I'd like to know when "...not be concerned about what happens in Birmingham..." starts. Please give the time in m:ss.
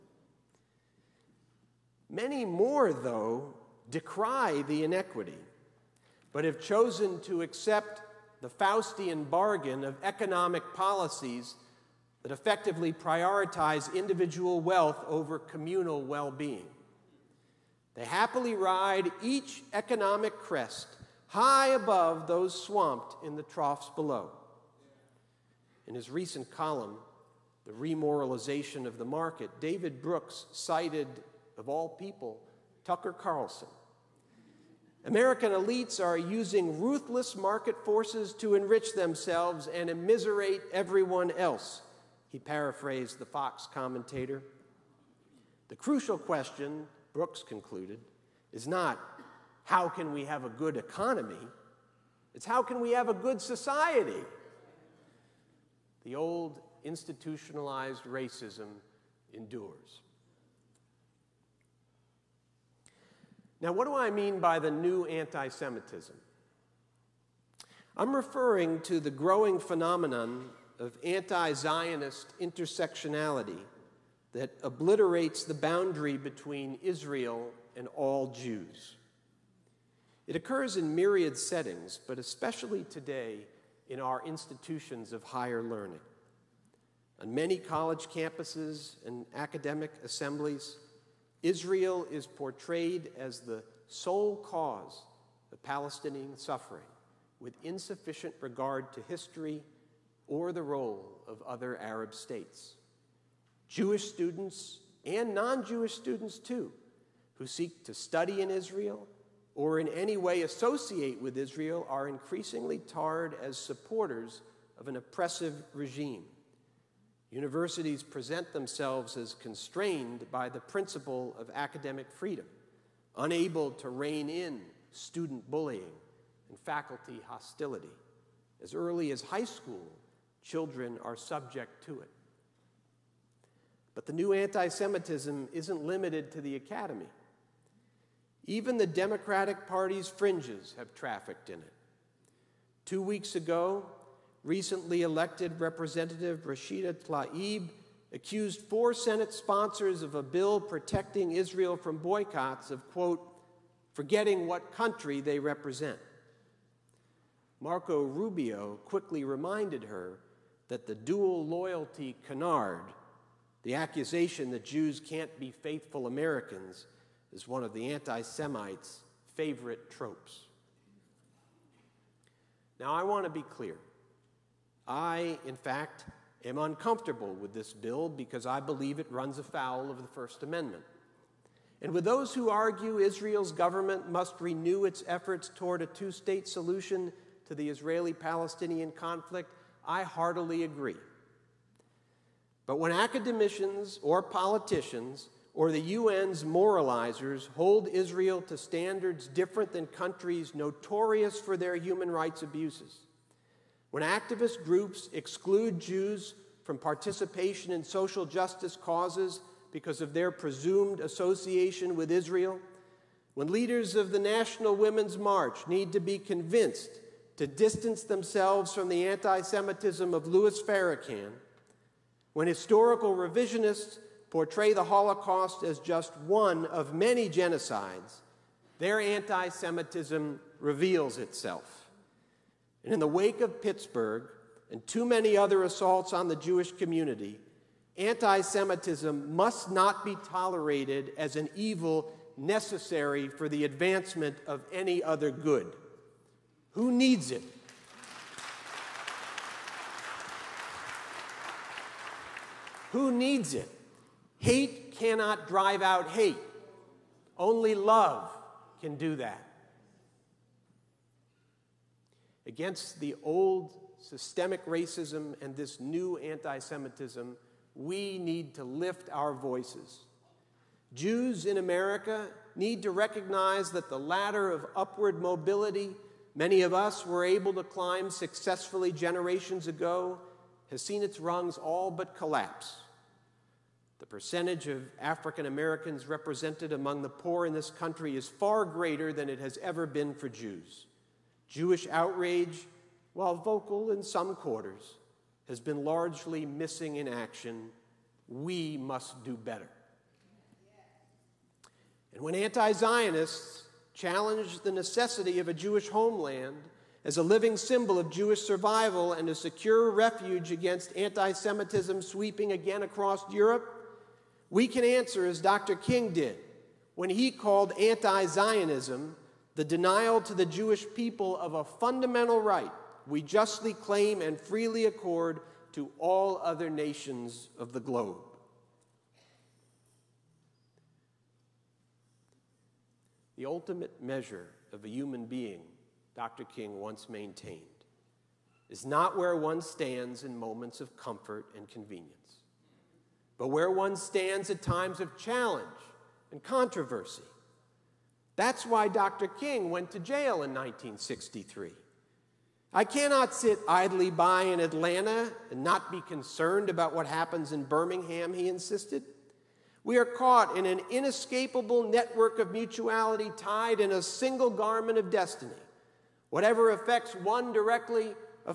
5:55.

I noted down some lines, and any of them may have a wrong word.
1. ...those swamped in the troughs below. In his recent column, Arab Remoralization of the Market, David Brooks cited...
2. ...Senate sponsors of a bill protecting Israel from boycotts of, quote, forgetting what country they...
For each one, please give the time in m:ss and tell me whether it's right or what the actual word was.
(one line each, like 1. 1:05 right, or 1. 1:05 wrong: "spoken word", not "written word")
1. 0:22 wrong: "The", not "Arab"
2. 2:28 right.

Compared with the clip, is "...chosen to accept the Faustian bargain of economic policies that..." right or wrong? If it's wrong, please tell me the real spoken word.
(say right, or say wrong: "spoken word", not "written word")
right.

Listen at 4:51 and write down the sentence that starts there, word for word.
Jewish outrage, while vocal in some quarters, has been largely missing in action.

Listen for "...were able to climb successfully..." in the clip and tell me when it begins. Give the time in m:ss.
4:37.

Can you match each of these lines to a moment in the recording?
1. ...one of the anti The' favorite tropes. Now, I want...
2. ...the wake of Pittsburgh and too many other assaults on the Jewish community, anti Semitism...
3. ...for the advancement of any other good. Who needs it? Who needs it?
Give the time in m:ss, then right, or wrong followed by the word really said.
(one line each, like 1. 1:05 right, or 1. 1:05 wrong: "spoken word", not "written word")
1. 2:47 wrong: "Semites", not "The"
2. 3:52 right
3. 4:03 right.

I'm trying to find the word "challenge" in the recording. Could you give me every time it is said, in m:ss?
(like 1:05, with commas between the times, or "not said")
5:03, 5:45.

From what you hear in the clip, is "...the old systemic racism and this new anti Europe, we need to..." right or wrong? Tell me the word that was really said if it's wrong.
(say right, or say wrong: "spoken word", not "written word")
wrong: "Semitism", not "Europe".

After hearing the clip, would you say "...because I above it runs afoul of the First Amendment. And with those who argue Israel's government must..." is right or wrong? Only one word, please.
wrong.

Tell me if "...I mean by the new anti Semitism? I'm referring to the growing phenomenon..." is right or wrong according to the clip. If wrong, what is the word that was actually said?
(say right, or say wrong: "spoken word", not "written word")
right.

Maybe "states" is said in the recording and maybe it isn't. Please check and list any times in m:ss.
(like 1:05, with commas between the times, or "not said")
1:42, 3:06.